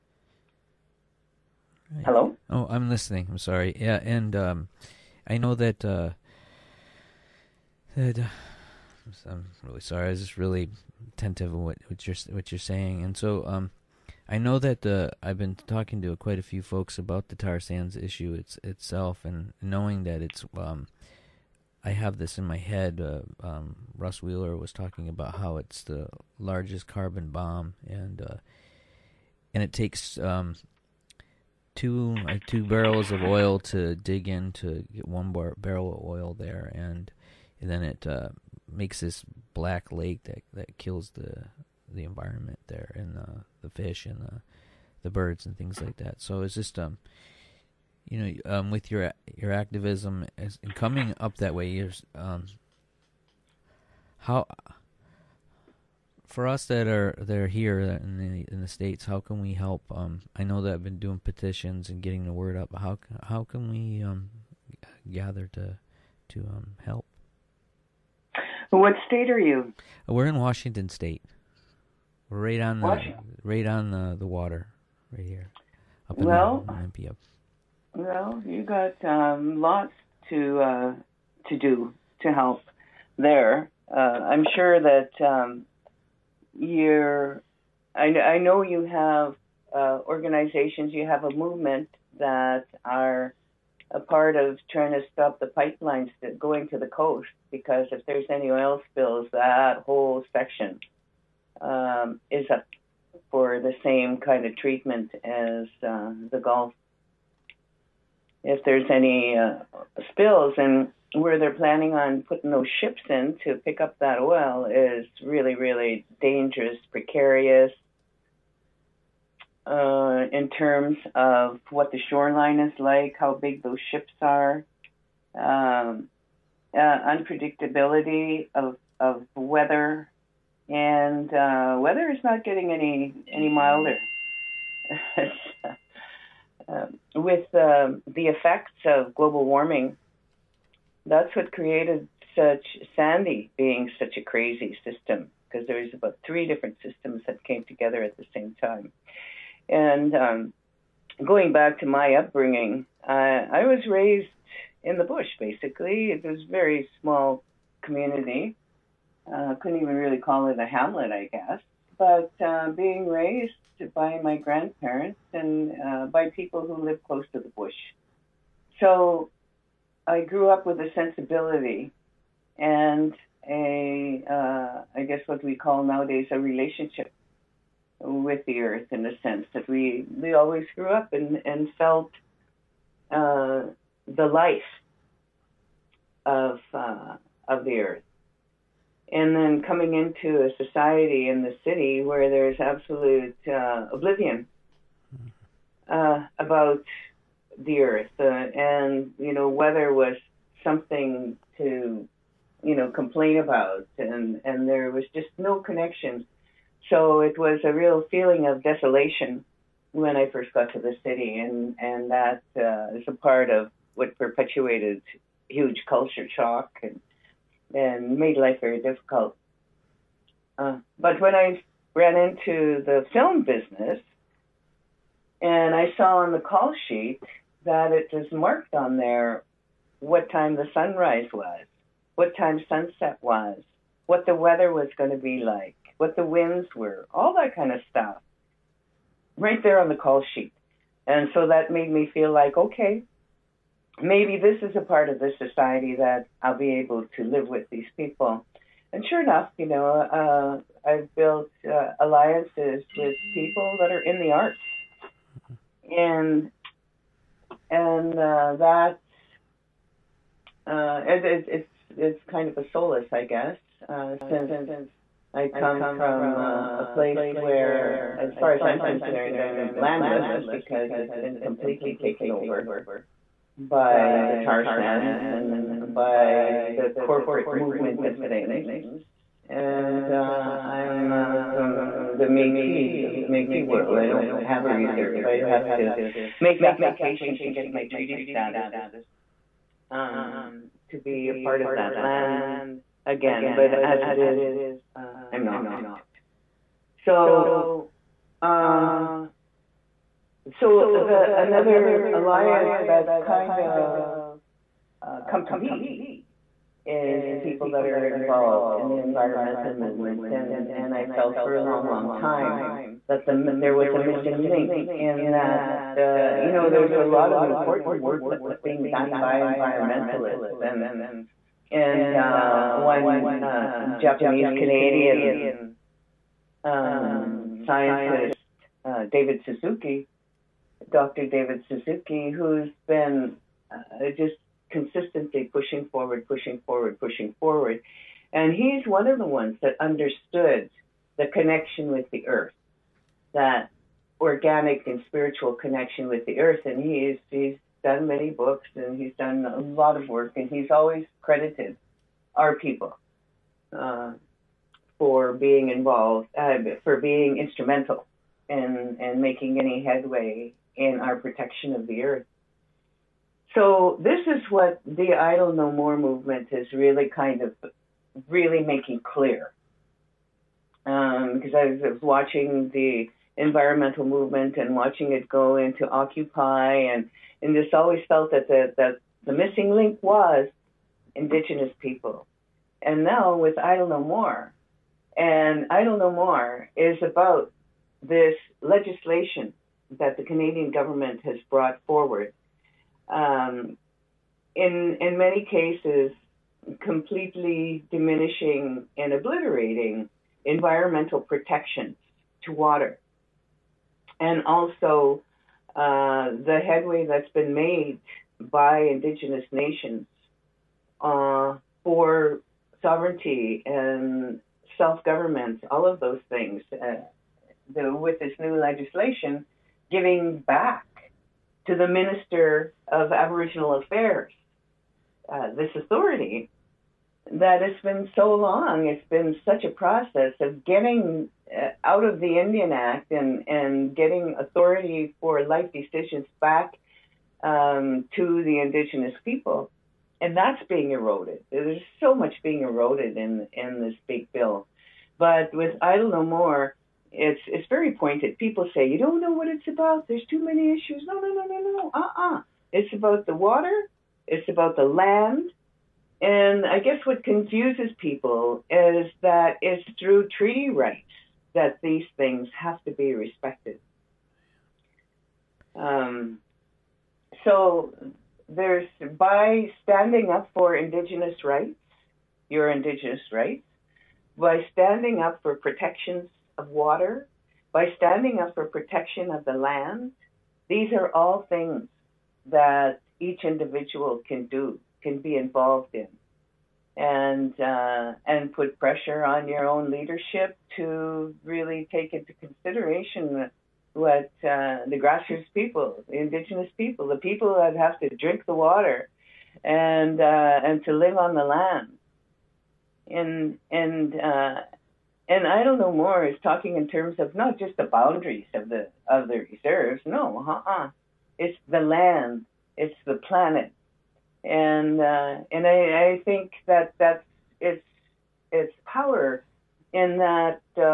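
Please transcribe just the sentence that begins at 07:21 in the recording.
There's so much being eroded in in this big bill.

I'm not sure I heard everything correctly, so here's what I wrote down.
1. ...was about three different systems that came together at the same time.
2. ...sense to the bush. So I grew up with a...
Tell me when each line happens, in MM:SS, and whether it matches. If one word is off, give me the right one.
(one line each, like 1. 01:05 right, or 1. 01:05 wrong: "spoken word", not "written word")
1. 02:25 right
2. 02:47 wrong: "close", not "sense".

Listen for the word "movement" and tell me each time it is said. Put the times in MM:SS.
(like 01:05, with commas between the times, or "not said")
01:31, 04:37, 05:09, 06:05, 06:14.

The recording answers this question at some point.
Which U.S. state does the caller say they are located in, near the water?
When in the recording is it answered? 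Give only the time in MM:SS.
01:10.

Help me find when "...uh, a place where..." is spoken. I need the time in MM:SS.
04:26.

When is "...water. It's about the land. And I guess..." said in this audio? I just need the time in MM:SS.
07:33.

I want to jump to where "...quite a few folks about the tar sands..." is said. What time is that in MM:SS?
00:16.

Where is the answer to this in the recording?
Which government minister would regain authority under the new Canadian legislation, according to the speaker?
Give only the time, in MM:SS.
07:01.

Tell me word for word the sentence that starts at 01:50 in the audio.
And where they're planning on putting those ships in to pick up that oil is really, really dangerous, precarious.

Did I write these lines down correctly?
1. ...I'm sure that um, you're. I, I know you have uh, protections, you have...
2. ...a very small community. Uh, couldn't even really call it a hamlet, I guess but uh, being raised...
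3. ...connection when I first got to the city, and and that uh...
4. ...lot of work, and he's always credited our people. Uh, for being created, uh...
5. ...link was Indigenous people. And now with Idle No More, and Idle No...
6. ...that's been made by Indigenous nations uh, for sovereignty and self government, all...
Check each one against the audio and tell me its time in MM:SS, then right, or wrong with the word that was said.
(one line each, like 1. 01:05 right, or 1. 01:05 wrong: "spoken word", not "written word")
1. 01:24 wrong: "organizations", not "protections"
2. 02:36 right
3. 03:28 wrong: "desolation", not "connection"
4. 05:49 wrong: "involved", not "created"
5. 06:19 right
6. 06:47 right.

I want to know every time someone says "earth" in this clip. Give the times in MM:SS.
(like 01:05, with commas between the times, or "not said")
02:58, 03:07, 03:17, 05:42, 05:46, 06:02.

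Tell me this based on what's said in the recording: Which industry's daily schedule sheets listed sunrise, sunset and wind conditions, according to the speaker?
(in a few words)
film business.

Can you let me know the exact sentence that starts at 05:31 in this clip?
David Suzuki, who's been uh, just consistently pushing forward, pushing forward, pushing forward.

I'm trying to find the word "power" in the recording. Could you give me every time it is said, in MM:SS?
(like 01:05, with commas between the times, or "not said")
08:38.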